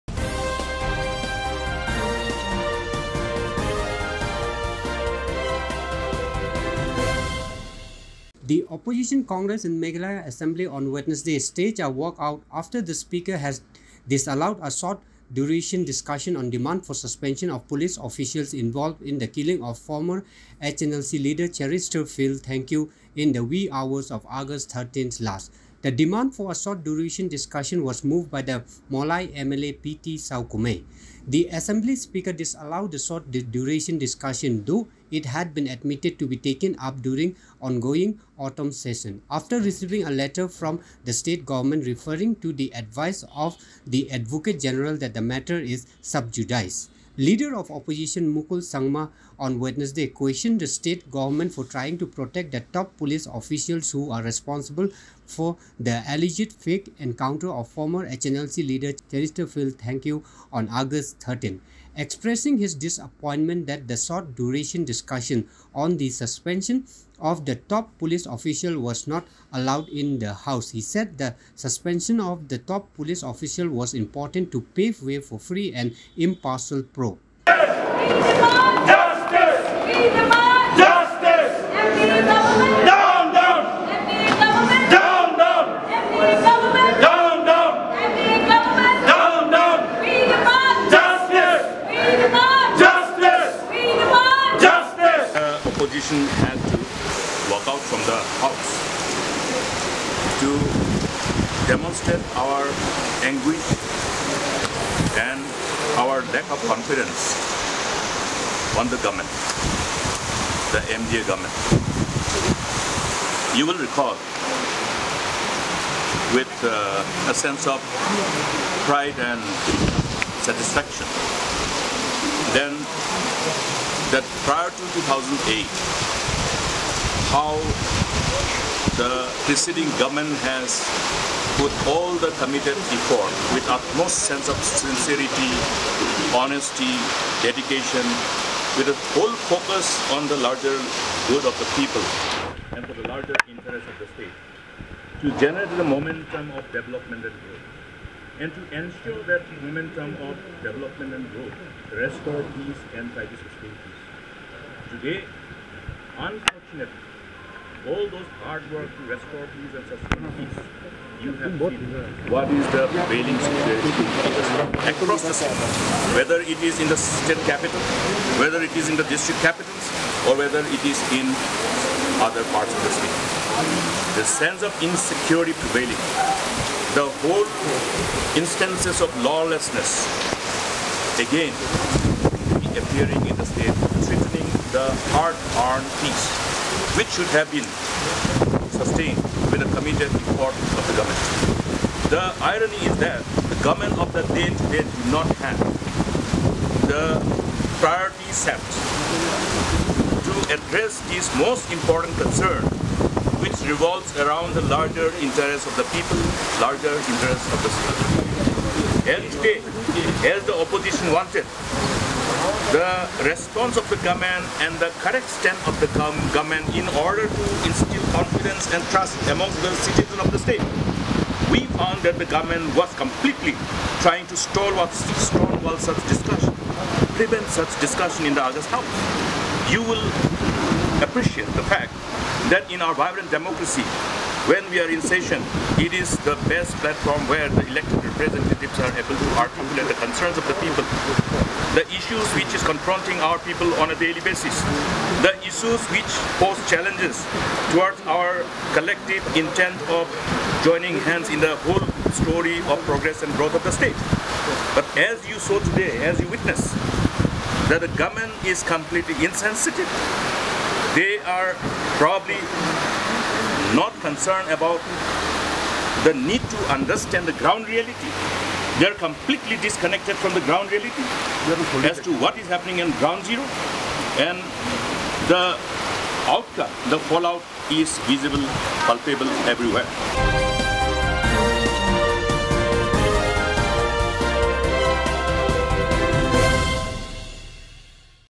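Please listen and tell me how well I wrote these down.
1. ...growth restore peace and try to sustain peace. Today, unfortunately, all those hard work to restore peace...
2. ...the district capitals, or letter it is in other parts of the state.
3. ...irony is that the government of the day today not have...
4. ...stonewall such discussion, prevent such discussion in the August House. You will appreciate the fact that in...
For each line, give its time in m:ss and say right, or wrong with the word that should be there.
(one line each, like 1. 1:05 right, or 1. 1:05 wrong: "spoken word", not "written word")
1. 2:31 right
2. 2:48 wrong: "whether", not "letter"
3. 3:12 right
4. 3:45 right.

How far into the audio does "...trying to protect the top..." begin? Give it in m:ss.
0:51.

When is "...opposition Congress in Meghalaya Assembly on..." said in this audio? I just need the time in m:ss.
0:08.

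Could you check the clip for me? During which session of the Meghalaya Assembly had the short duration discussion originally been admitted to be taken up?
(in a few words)
autumn session.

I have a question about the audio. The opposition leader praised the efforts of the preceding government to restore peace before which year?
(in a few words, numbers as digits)
2008.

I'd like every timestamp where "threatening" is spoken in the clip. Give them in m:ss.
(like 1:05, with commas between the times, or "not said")
3:04.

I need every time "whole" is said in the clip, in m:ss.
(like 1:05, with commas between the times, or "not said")
2:57, 4:11.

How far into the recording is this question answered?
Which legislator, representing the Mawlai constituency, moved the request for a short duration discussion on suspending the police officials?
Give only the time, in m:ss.
0:29.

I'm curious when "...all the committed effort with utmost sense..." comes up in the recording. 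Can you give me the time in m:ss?
2:11.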